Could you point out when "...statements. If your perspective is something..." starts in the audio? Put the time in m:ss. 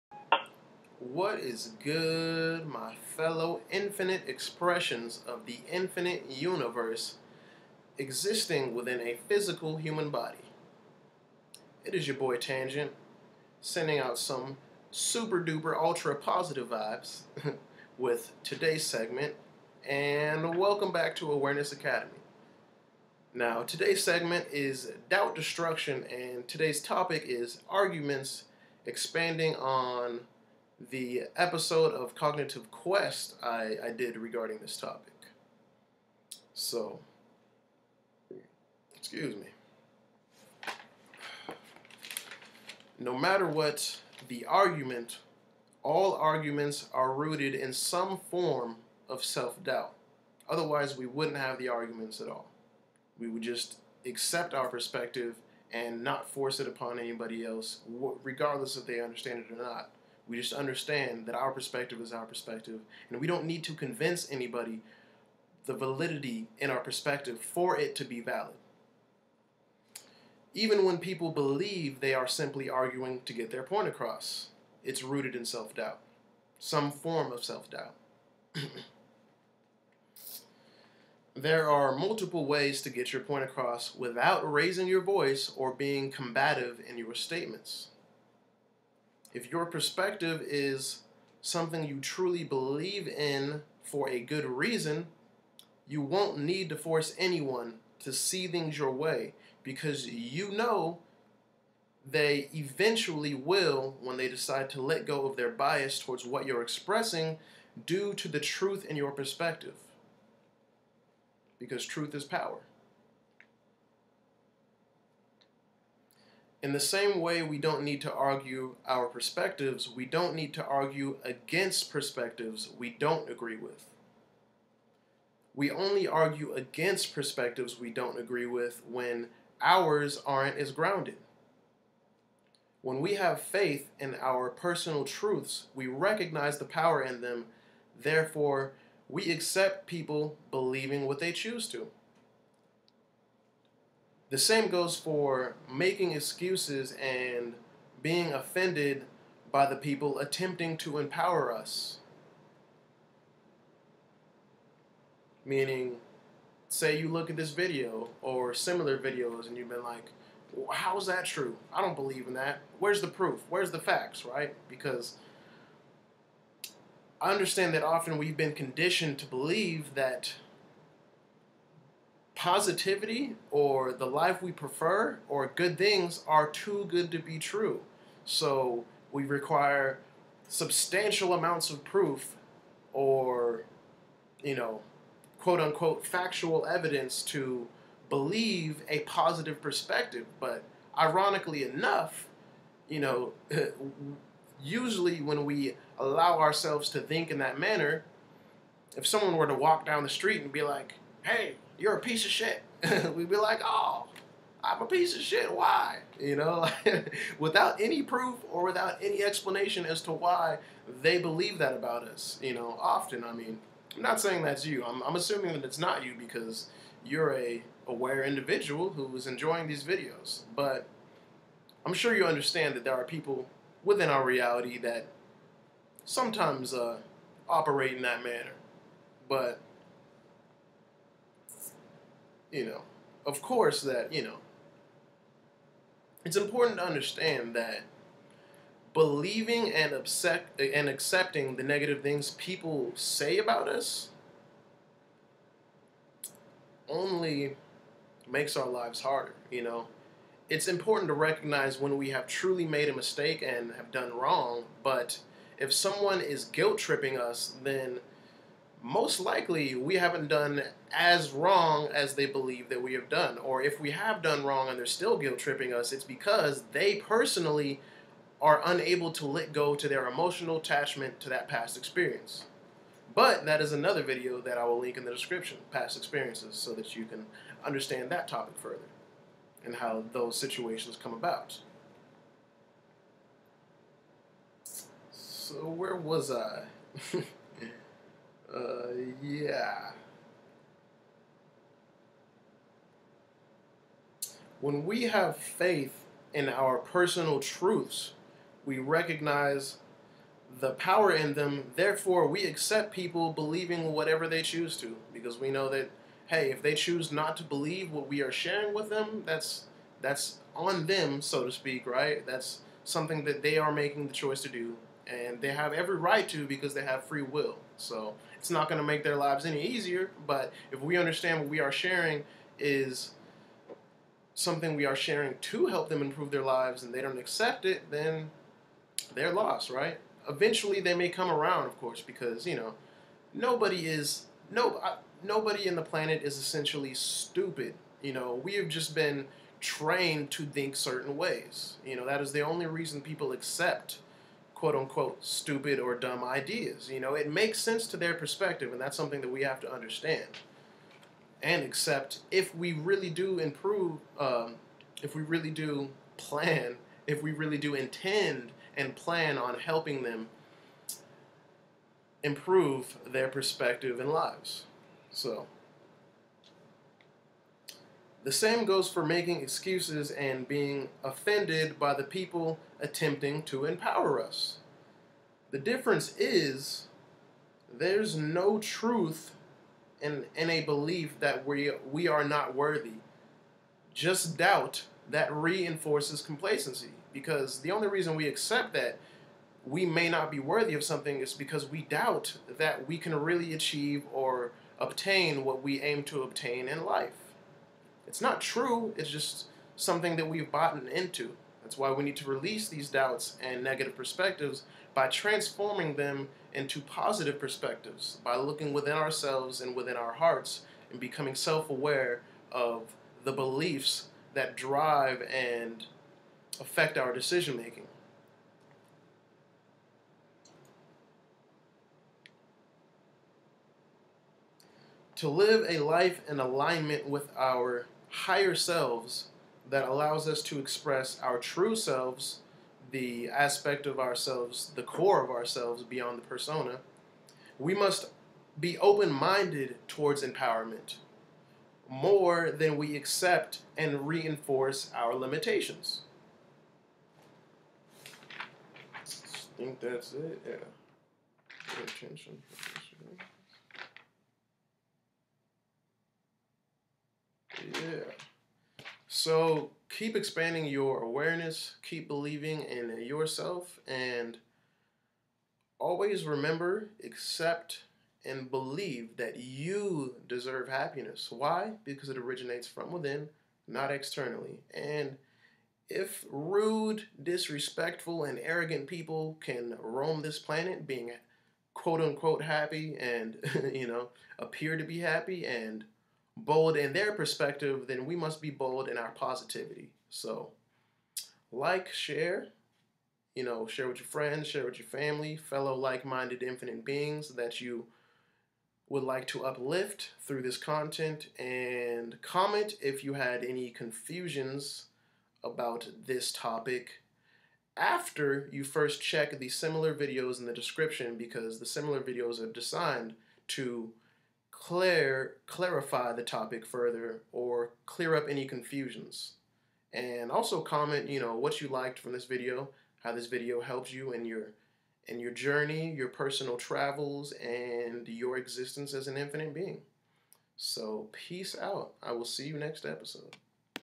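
1:27.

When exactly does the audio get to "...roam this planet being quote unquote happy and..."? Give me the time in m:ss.
7:59.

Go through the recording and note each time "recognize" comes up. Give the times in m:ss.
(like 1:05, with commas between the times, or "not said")
2:15, 4:11, 4:58.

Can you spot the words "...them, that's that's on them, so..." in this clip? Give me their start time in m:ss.
5:08.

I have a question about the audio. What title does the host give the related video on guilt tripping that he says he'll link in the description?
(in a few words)
past experiences.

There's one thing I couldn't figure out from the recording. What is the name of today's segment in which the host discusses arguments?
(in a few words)
doubt destruction.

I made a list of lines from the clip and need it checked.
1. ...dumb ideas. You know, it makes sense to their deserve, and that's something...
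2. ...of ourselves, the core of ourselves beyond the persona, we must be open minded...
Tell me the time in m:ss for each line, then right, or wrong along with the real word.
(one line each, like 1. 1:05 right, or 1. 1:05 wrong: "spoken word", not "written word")
1. 5:45 wrong: "perspective", not "deserve"
2. 7:13 right.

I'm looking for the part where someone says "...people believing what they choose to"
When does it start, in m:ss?
2:19.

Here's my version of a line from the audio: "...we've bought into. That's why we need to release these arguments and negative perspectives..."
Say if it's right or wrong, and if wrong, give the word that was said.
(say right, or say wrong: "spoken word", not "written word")
wrong: "doubts", not "arguments".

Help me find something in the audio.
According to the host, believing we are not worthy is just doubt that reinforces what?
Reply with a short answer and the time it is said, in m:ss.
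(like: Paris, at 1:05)
complacency, at 6:26.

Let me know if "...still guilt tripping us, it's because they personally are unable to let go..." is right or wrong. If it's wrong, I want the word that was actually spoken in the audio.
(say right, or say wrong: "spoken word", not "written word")
right.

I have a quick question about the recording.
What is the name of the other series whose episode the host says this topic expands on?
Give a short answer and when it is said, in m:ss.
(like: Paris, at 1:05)
Cognitive Quest, at 0:32.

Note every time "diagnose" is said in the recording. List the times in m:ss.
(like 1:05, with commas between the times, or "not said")
not said.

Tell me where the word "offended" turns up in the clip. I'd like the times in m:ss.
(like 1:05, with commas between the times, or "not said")
2:28, 6:11.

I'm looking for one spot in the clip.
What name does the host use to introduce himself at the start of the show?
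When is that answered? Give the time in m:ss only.
0:12.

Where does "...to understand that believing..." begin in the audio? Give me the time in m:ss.
3:56.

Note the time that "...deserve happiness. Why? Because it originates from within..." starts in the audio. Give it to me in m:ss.
7:50.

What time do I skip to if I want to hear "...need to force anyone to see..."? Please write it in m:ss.
1:36.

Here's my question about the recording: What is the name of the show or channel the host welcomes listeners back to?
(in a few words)
Awareness Academy.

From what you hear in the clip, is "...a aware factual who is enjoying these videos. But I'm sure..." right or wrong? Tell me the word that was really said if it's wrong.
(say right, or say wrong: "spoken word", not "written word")
wrong: "individual", not "factual".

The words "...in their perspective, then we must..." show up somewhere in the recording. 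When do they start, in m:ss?
8:06.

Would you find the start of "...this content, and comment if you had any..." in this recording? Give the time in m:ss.
8:20.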